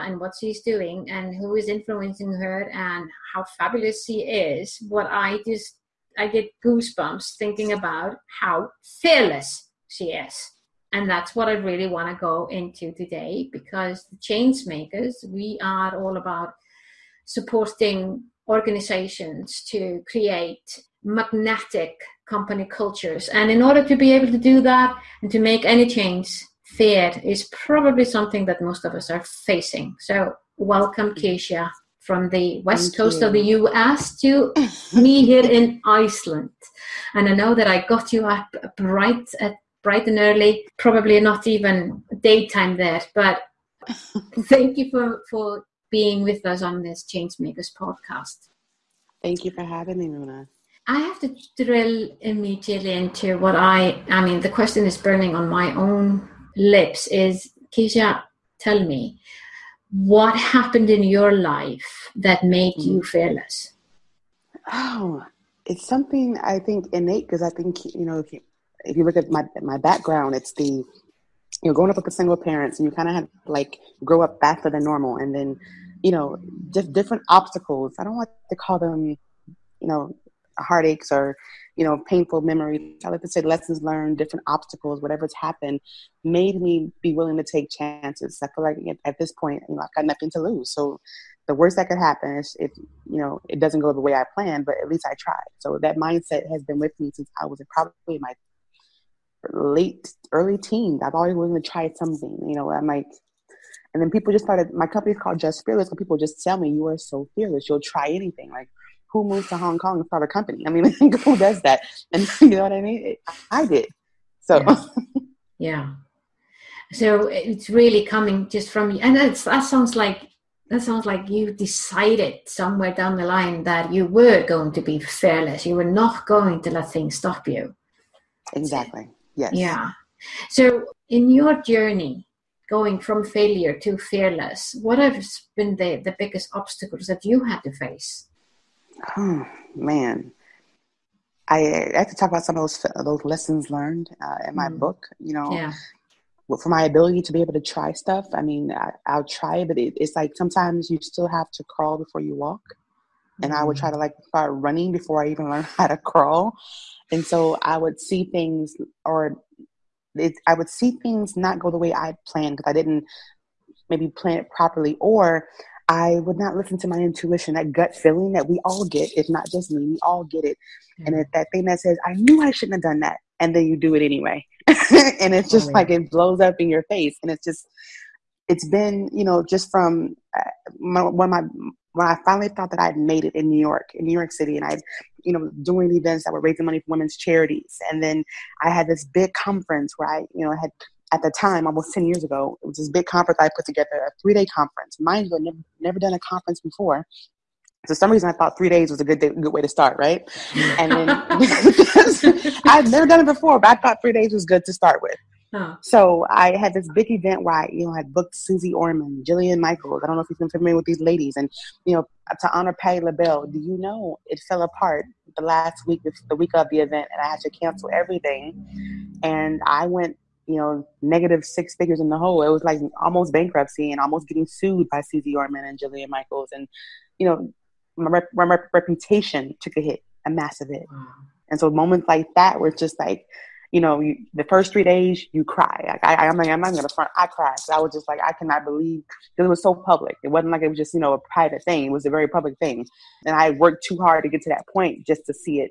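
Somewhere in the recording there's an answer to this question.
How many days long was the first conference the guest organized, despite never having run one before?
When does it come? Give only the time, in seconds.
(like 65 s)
194 s.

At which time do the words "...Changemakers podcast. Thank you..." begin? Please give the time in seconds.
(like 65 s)
47 s.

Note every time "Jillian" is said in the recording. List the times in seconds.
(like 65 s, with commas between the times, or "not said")
209 s, 225 s.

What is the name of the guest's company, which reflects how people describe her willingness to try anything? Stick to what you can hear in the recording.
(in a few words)
Just Fearless.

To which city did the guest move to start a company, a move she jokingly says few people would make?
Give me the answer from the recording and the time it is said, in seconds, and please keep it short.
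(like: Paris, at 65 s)
Hong Kong, at 109 s.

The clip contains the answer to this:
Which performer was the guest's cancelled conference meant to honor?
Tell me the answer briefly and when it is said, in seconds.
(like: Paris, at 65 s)
Patti LaBelle, at 212 s.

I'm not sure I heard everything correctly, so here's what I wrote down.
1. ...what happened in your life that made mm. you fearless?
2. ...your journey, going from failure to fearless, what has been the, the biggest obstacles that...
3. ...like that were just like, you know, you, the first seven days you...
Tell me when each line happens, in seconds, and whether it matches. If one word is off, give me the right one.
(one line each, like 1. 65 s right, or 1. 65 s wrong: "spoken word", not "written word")
1. 59 s right
2. 131 s right
3. 232 s wrong: "three", not "seven".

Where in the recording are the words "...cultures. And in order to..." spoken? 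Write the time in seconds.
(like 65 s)
22 s.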